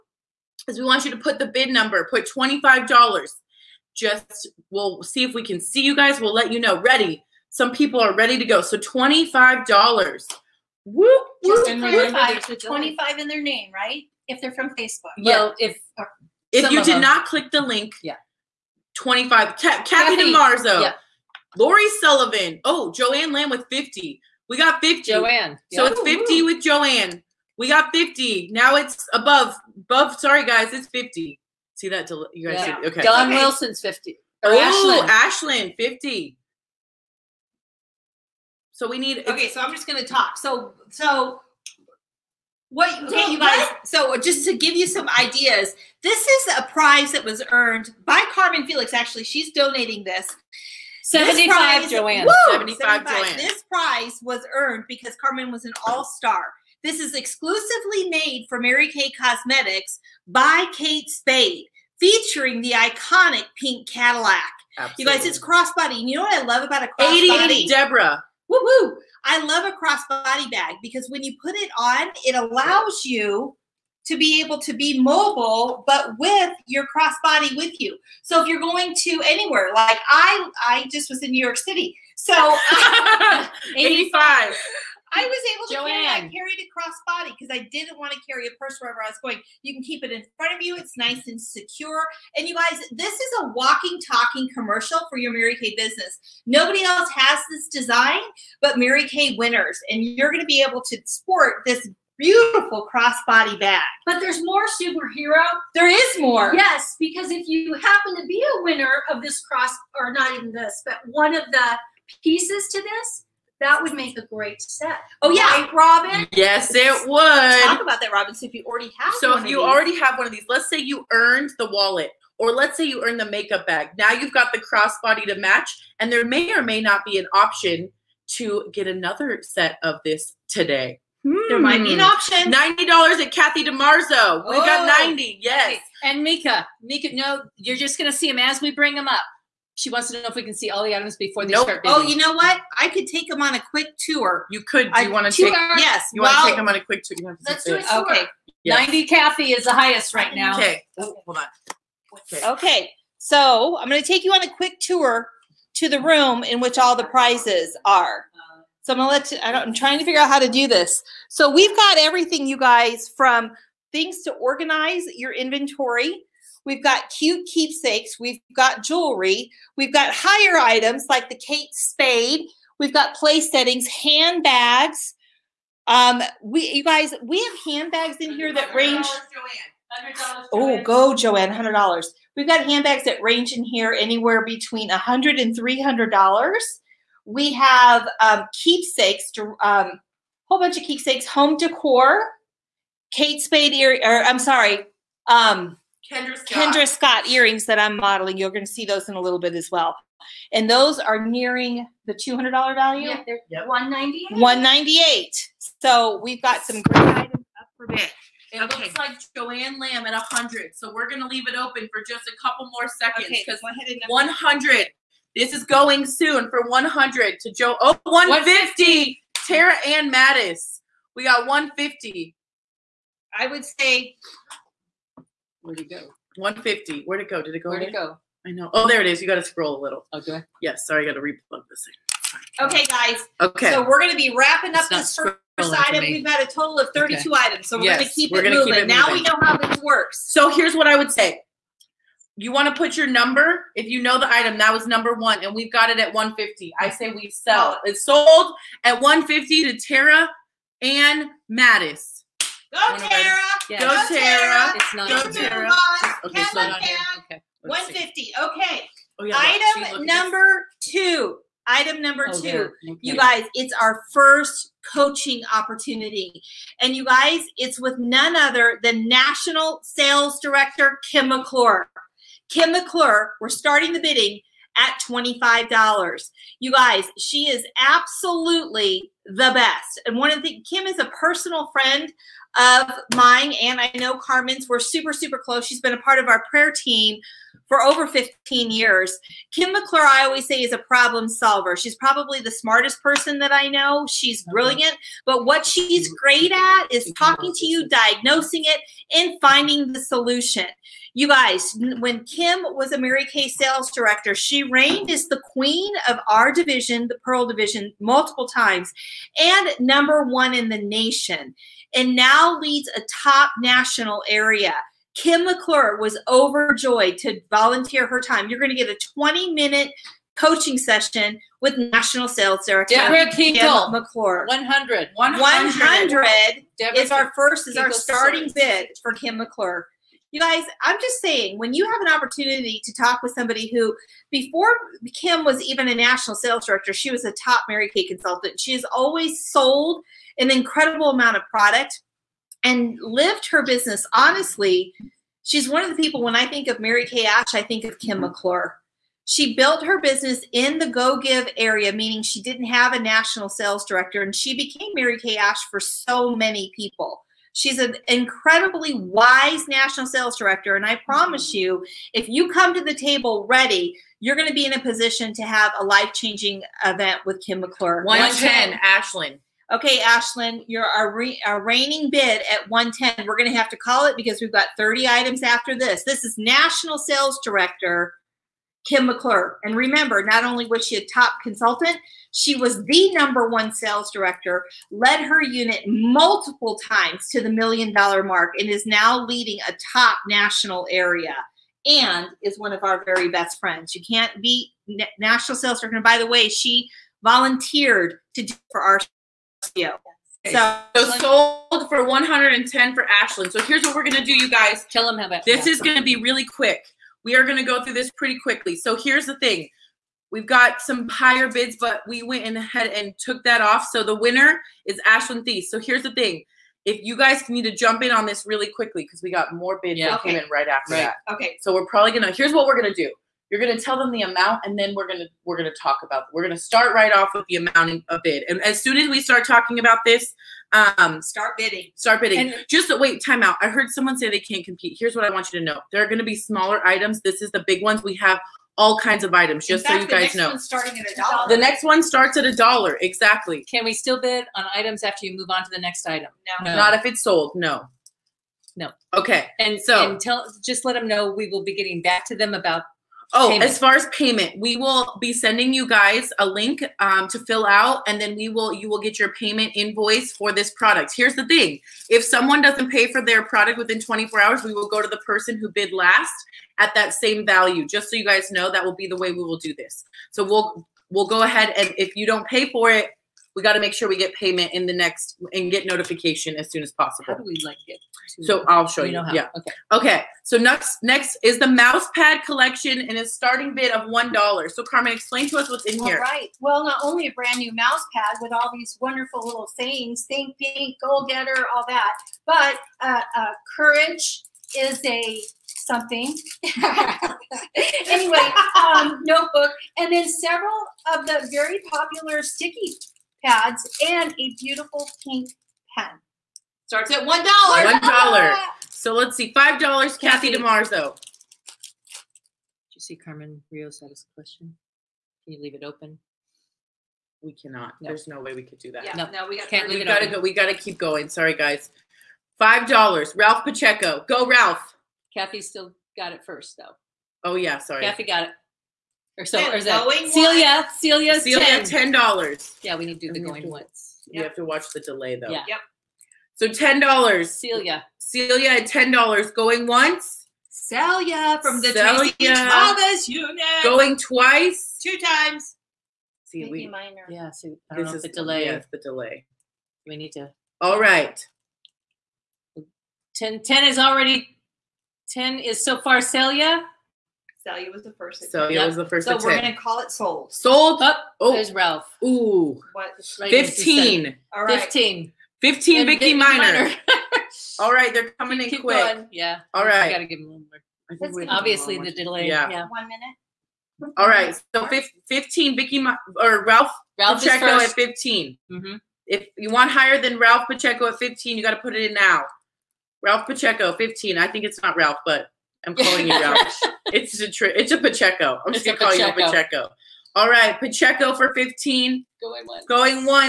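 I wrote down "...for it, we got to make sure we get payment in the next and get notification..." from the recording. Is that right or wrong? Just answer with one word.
right.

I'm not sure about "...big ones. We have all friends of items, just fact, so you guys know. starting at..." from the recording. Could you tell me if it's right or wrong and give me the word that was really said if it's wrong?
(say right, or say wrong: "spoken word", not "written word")
wrong: "kinds", not "friends".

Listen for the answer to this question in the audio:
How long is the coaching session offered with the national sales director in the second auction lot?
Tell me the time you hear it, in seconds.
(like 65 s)
319 s.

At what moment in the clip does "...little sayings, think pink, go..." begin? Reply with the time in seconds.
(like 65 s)
489 s.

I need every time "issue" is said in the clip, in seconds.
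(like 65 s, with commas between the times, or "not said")
not said.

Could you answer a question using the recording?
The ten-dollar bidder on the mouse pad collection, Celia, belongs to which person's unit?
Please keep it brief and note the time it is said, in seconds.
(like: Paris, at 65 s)
Tracy Thomas, at 541 s.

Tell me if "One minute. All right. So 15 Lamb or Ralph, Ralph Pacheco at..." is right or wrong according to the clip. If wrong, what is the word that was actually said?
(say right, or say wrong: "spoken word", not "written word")
wrong: "Vicky", not "Lamb".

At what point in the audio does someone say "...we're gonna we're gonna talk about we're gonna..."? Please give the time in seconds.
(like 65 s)
424 s.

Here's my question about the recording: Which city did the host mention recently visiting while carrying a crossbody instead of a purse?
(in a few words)
New York City.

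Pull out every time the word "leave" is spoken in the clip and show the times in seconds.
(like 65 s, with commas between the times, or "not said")
211 s, 515 s.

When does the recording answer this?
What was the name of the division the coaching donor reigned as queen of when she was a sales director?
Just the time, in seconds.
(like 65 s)
307 s.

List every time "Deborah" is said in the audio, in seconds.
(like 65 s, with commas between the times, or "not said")
67 s, 322 s.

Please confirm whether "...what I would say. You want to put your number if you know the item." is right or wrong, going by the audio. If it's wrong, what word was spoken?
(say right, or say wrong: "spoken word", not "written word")
right.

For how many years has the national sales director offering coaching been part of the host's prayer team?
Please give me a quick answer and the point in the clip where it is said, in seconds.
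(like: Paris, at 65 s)
over 15 years, at 287 s.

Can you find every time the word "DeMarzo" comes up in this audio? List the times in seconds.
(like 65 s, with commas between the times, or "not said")
20 s, 510 s.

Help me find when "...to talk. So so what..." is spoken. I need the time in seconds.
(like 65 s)
40 s.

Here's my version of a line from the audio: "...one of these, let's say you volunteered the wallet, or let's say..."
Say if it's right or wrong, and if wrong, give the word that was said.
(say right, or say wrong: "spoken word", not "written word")
wrong: "earned", not "volunteered".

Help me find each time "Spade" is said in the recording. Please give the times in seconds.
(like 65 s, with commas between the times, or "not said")
61 s, 171 s, 193 s.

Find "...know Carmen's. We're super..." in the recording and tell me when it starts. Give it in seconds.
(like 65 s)
283 s.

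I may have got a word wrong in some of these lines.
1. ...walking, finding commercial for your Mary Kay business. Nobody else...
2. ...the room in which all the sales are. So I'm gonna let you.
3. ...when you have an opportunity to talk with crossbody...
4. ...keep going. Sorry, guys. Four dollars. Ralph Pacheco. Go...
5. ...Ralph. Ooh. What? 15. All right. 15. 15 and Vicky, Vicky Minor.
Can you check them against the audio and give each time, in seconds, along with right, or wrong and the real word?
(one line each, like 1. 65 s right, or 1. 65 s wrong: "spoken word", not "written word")
1. 93 s wrong: "talking", not "finding"
2. 155 s wrong: "prizes", not "sales"
3. 331 s wrong: "somebody", not "crossbody"
4. 520 s wrong: "Five", not "Four"
5. 561 s right.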